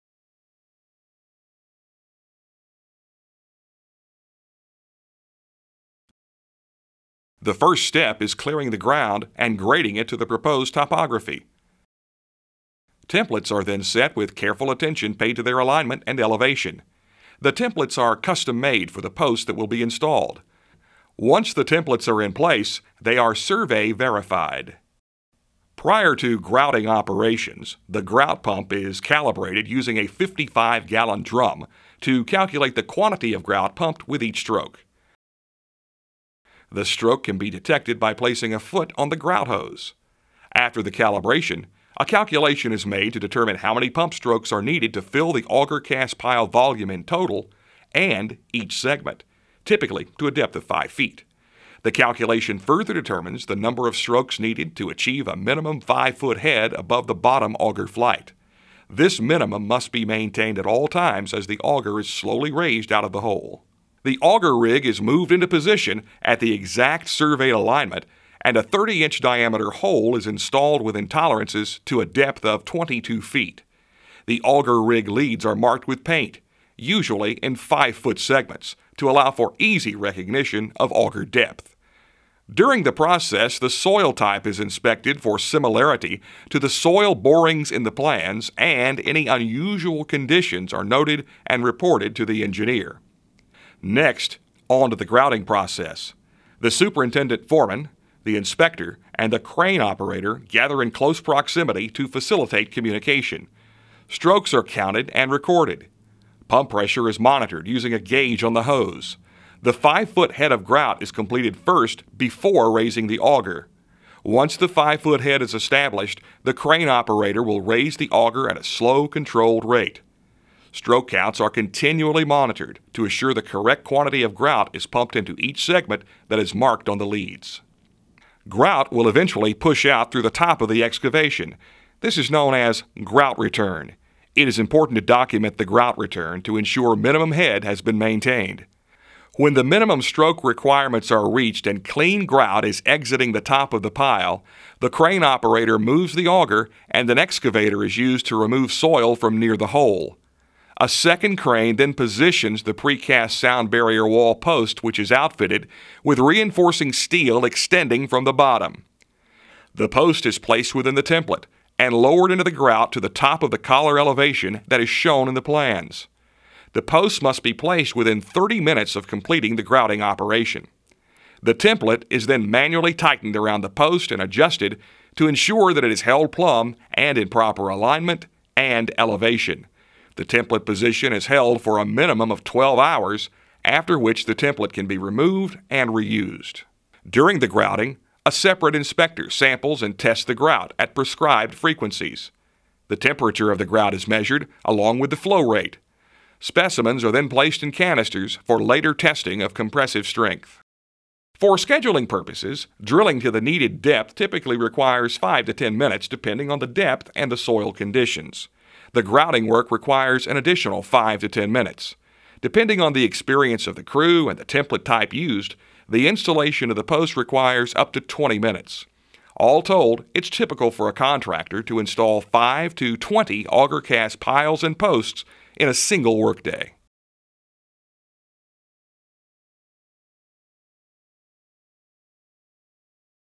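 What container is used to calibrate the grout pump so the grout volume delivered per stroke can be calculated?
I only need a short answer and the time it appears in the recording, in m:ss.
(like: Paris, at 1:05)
55 gallon drum, at 0:30.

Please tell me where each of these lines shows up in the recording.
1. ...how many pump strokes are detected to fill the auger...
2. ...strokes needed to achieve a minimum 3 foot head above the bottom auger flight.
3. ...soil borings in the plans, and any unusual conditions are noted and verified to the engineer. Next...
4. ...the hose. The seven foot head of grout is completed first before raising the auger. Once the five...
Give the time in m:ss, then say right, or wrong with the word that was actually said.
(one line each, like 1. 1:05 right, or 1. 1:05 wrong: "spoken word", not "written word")
1. 0:43 wrong: "needed", not "detected"
2. 0:53 wrong: "5", not "3"
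3. 1:26 wrong: "reported", not "verified"
4. 1:48 wrong: "five", not "seven".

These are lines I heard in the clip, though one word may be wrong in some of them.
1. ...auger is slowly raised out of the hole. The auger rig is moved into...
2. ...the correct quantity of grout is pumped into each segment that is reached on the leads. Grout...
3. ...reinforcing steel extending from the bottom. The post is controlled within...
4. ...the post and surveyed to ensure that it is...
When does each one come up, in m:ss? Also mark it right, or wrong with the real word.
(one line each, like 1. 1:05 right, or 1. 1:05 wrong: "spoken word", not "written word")
1. 1:01 right
2. 2:03 wrong: "marked", not "reached"
3. 2:36 wrong: "placed", not "controlled"
4. 2:53 wrong: "adjusted", not "surveyed".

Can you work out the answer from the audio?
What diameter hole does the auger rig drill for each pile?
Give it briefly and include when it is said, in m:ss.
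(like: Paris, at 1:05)
30 inch, at 1:08.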